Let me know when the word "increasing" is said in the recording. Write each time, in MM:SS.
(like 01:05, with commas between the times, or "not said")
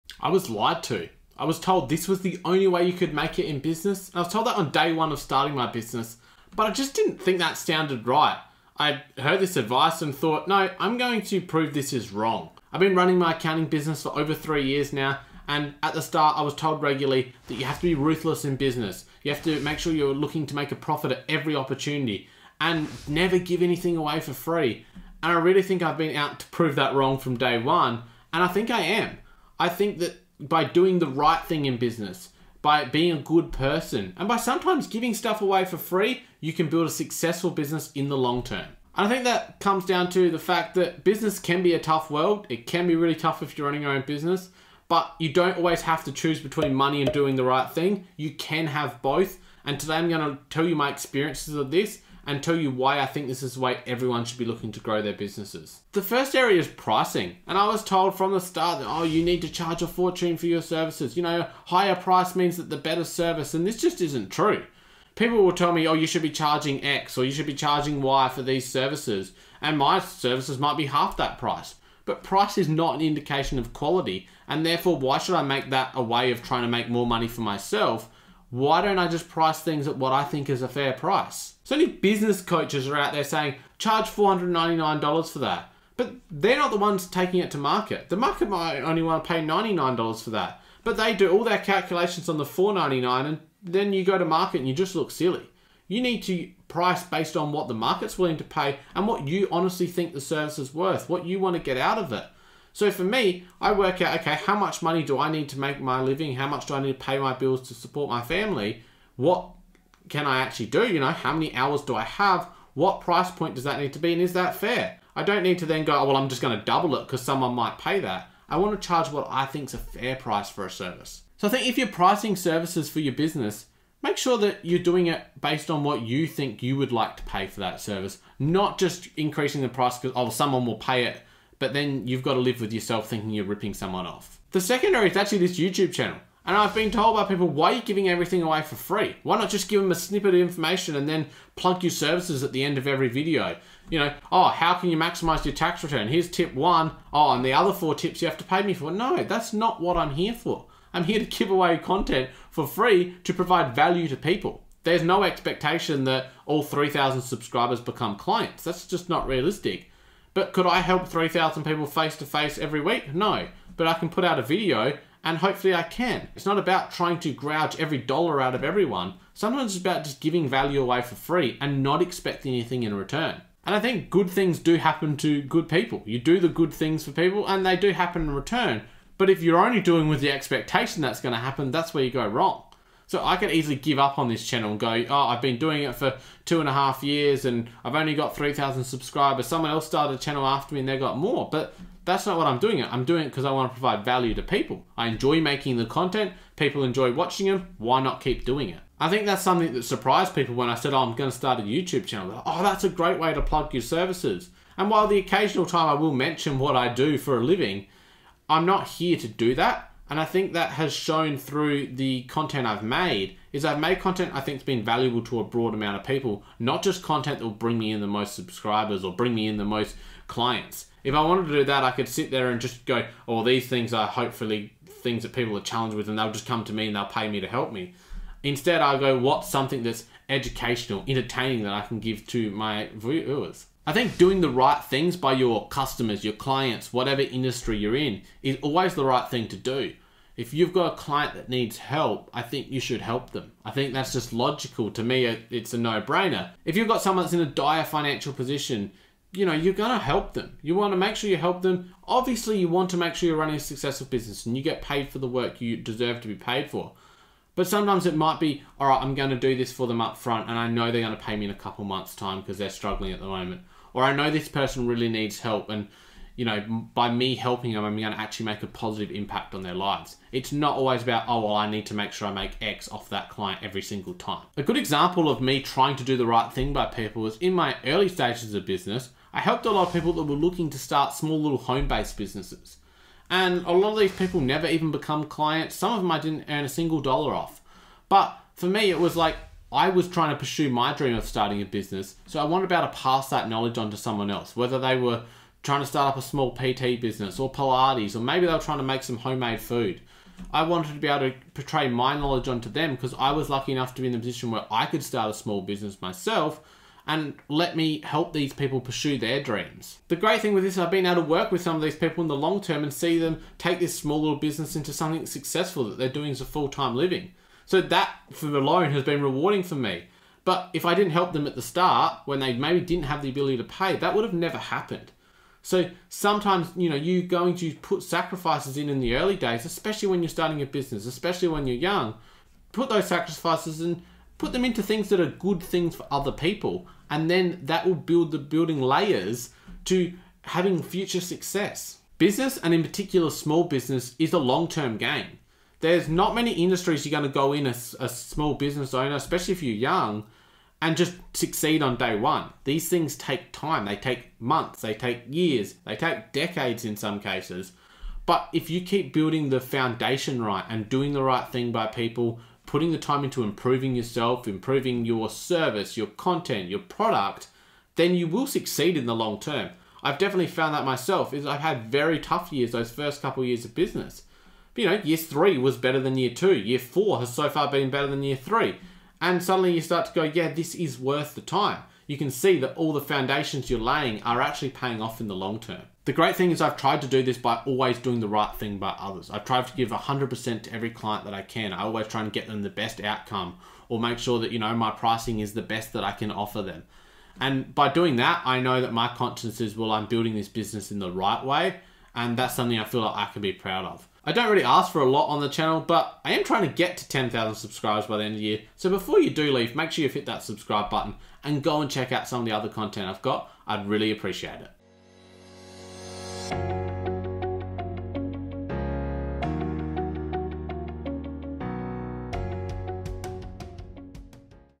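02:09.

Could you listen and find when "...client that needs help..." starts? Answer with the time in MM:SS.
04:00.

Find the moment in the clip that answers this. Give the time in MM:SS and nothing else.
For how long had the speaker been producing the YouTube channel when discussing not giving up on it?
03:06.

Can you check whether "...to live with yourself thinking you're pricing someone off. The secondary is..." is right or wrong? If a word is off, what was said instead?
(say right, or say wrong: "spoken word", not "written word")
wrong: "ripping", not "pricing".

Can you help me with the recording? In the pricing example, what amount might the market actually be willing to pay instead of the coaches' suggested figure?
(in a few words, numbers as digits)
$99.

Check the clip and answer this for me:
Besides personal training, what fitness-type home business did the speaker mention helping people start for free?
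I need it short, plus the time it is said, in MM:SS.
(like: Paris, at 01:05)
Pilates, at 04:57.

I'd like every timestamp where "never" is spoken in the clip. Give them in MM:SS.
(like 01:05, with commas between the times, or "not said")
00:23, 04:44, 05:24.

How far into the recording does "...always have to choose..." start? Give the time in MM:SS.
00:45.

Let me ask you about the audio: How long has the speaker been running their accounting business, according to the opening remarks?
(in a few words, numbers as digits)
Over three years.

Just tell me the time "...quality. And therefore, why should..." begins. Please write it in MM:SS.
01:13.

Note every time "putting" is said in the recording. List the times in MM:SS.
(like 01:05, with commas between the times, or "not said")
06:02.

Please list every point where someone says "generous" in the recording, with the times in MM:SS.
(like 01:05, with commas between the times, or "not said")
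not said.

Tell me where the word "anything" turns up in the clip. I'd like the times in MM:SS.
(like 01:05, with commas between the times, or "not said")
00:23, 02:52.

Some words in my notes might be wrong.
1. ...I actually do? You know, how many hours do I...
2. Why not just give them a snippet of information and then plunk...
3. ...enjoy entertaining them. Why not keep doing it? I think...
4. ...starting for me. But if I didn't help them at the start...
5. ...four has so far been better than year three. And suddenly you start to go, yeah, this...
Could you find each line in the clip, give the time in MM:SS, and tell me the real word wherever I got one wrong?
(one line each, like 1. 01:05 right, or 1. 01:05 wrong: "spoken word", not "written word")
1. 01:50 right
2. 02:19 right
3. 03:16 wrong: "watching", not "entertaining"
4. 05:19 wrong: "rewarding", not "starting"
5. 06:16 right.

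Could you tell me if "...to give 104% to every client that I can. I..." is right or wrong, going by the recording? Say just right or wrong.
wrong.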